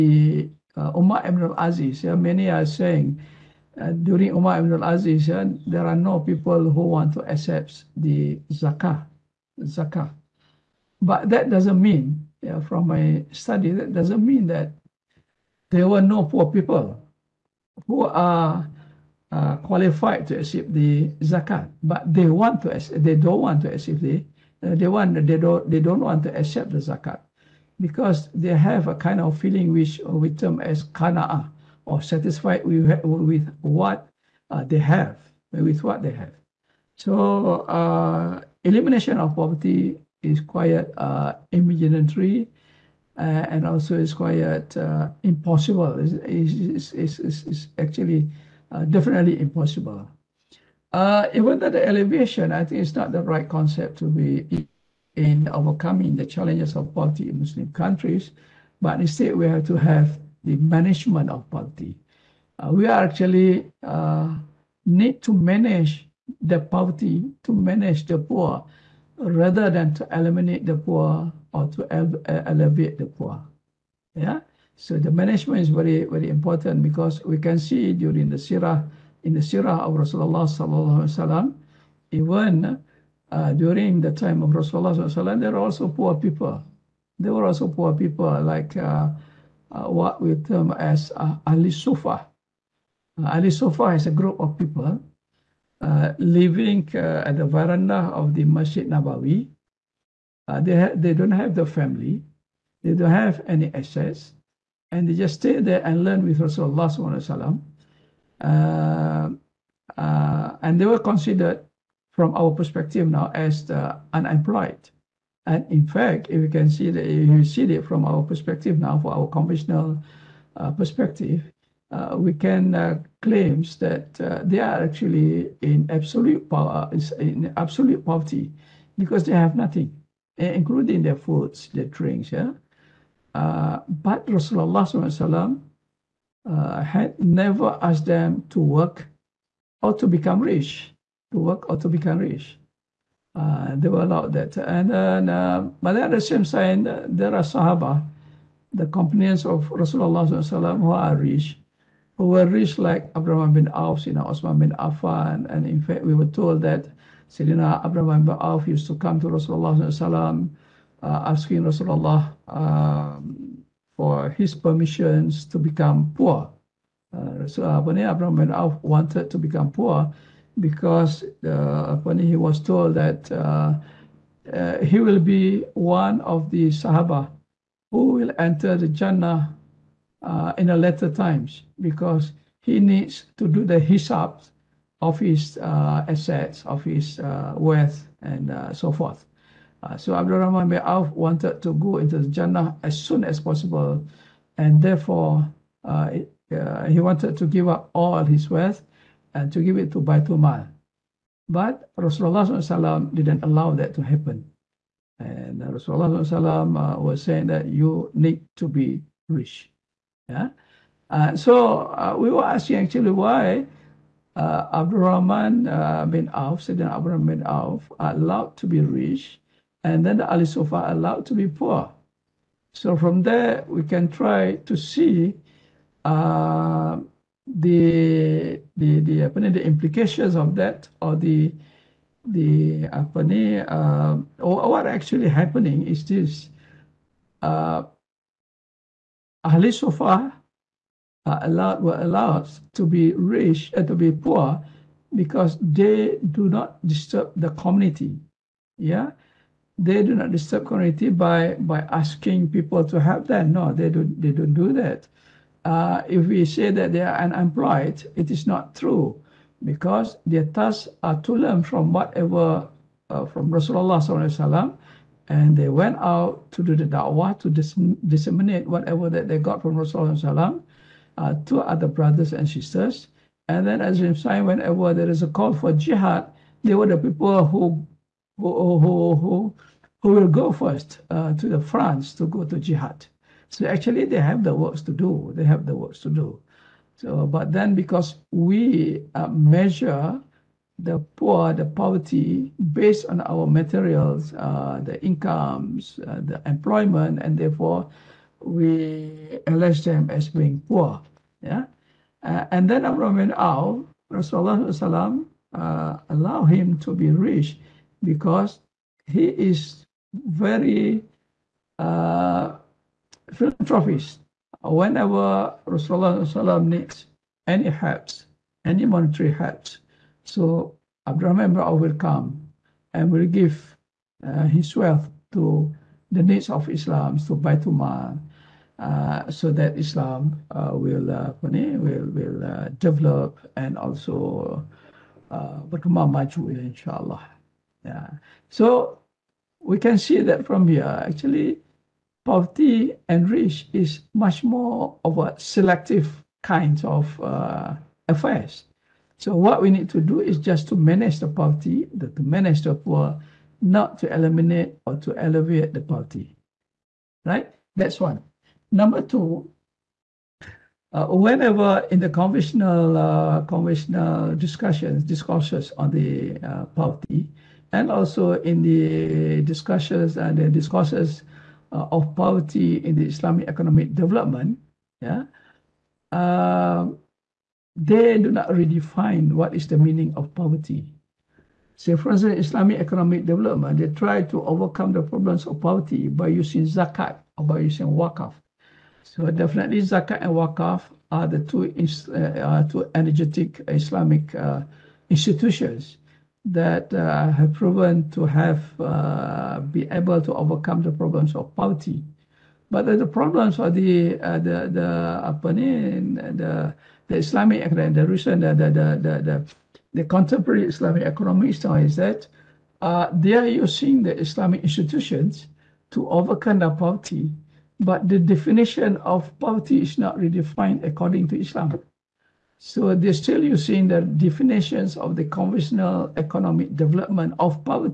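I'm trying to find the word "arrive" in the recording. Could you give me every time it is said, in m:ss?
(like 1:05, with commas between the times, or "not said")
not said.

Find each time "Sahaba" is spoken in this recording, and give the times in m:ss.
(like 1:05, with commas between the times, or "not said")
2:27, 2:56.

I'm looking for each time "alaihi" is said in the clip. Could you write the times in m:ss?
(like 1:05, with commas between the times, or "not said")
1:21, 1:25.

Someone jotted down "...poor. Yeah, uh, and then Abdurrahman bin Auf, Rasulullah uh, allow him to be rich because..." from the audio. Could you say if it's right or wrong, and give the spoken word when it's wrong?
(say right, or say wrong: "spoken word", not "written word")
right.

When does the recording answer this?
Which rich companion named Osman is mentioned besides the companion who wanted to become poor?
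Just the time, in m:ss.
2:34.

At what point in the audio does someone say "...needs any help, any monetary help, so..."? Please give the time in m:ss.
5:16.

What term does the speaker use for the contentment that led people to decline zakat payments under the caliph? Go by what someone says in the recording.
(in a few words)
kanaa.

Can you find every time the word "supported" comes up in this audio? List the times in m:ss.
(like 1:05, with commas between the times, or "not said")
not said.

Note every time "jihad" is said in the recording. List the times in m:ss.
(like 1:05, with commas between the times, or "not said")
4:35, 4:42.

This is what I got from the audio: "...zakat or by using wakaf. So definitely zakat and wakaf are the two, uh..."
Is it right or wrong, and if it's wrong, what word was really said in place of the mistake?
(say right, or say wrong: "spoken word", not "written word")
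right.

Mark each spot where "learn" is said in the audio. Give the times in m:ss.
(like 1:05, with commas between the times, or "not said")
1:46, 4:21.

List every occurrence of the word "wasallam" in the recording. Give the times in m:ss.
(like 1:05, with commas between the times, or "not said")
1:21, 1:25, 4:24.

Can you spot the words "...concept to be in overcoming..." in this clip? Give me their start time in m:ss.
0:53.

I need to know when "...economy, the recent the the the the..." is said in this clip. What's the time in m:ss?
6:47.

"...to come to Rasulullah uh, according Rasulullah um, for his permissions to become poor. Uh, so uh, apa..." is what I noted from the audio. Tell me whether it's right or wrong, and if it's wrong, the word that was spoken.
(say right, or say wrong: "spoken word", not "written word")
wrong: "asking", not "according".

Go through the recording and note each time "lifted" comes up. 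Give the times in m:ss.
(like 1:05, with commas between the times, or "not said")
not said.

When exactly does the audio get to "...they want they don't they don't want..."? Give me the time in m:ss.
0:24.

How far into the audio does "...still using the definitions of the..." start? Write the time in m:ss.
7:03.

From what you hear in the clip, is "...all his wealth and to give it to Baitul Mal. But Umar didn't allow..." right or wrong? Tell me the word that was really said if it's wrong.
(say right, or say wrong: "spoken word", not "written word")
wrong: "Rasulullah", not "Umar".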